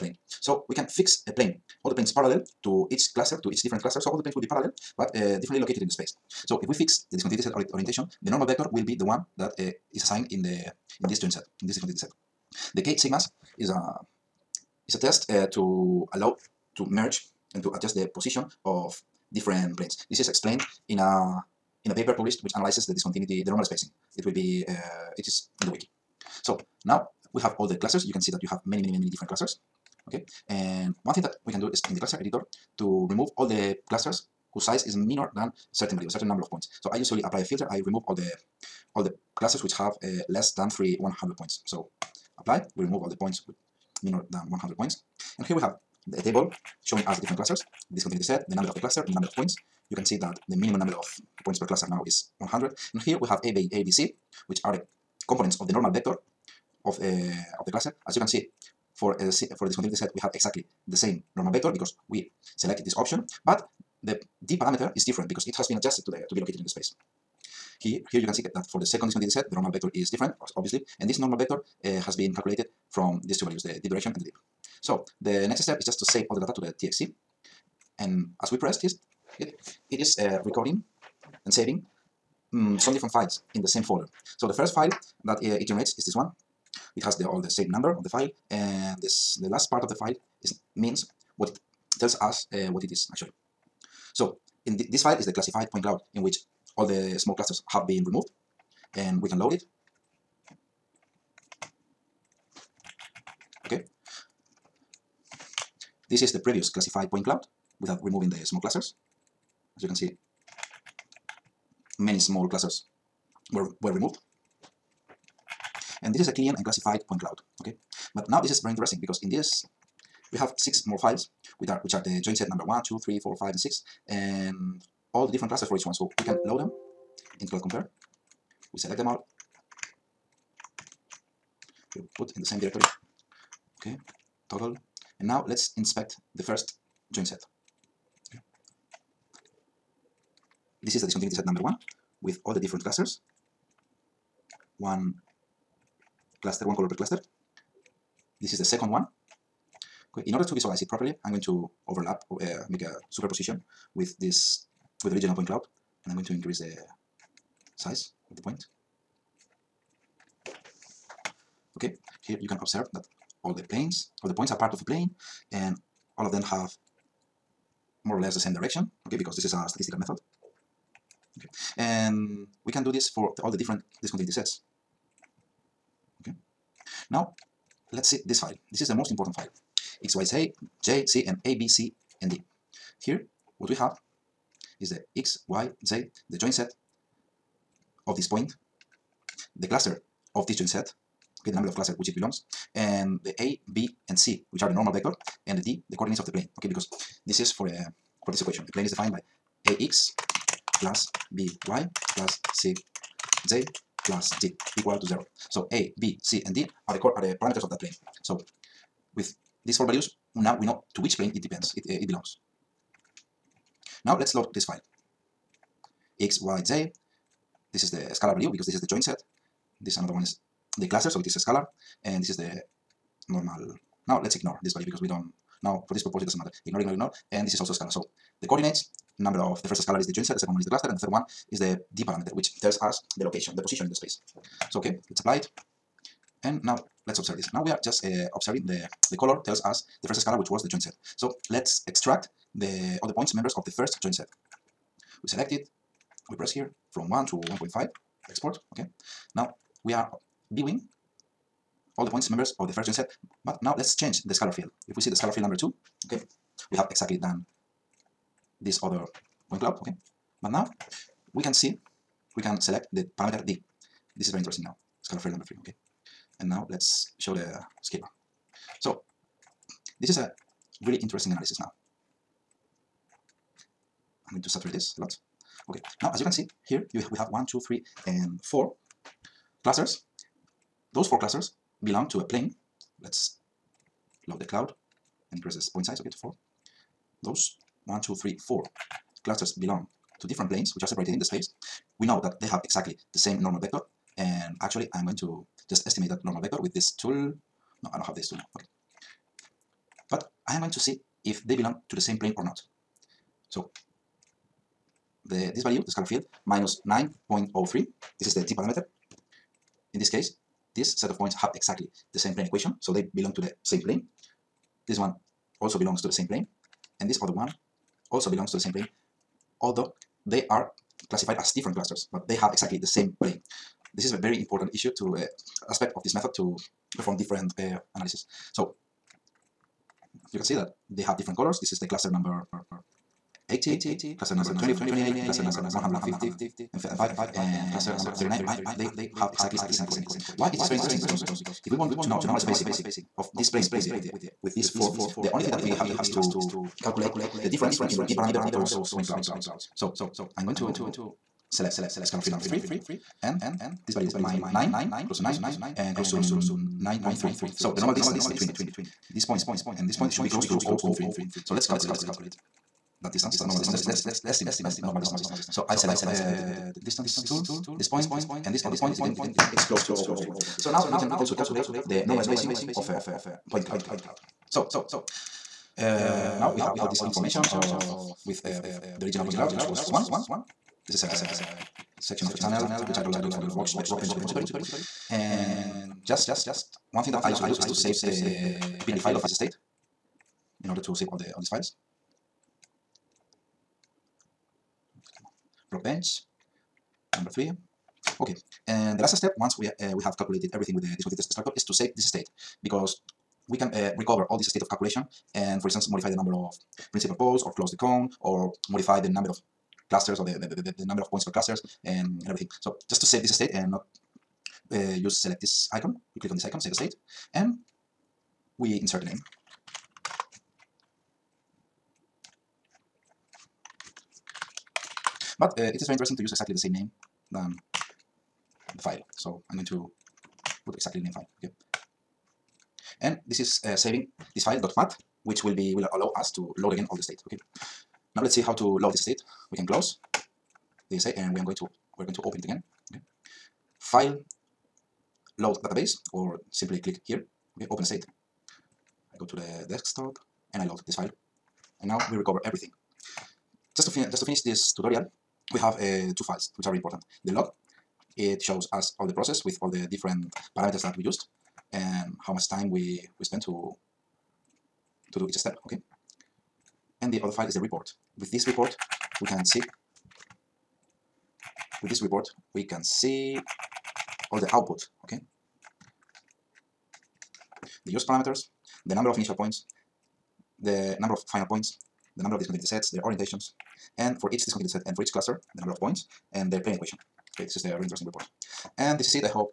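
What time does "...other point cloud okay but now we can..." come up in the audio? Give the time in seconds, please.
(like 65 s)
258 s.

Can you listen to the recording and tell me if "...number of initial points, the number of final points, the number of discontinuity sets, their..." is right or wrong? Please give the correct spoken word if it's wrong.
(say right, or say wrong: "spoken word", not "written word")
right.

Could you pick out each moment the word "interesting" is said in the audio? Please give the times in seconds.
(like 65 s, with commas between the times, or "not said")
118 s, 264 s, 270 s, 340 s, 425 s, 487 s.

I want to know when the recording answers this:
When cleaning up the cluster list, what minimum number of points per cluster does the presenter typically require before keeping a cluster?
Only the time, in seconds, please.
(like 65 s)
44 s.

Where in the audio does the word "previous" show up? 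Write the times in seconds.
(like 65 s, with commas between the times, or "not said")
106 s.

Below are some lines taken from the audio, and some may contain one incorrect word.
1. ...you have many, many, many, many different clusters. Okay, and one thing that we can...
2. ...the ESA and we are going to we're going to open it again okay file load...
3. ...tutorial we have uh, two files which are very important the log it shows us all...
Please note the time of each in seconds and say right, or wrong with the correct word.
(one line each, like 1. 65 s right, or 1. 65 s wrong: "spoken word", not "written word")
1. 28 s right
2. 440 s right
3. 454 s right.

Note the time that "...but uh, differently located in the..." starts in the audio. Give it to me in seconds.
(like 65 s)
4 s.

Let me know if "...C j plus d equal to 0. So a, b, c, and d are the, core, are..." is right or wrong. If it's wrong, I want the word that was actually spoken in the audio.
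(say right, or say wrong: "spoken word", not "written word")
right.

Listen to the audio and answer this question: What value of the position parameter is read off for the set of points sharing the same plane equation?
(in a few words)
-9.03.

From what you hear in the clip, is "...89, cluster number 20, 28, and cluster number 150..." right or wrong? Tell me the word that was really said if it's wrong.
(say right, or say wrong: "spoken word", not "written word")
wrong: "80", not "89".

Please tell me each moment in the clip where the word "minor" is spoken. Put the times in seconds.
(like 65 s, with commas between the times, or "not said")
34 s, 44 s.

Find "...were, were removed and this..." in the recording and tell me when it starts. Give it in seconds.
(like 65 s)
113 s.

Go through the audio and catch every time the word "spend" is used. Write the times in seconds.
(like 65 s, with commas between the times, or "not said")
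463 s.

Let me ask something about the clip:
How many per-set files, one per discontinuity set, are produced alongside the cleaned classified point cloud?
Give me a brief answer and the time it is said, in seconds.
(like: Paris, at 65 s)
6, at 120 s.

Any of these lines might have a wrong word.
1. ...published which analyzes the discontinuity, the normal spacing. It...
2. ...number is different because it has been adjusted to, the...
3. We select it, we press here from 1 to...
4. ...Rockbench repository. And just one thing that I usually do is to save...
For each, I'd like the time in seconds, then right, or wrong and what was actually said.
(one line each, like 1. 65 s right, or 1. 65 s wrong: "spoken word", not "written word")
1. 22 s right
2. 64 s wrong: "parameter", not "number"
3. 245 s right
4. 383 s right.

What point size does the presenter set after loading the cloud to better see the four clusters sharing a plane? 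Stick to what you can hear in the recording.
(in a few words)
4.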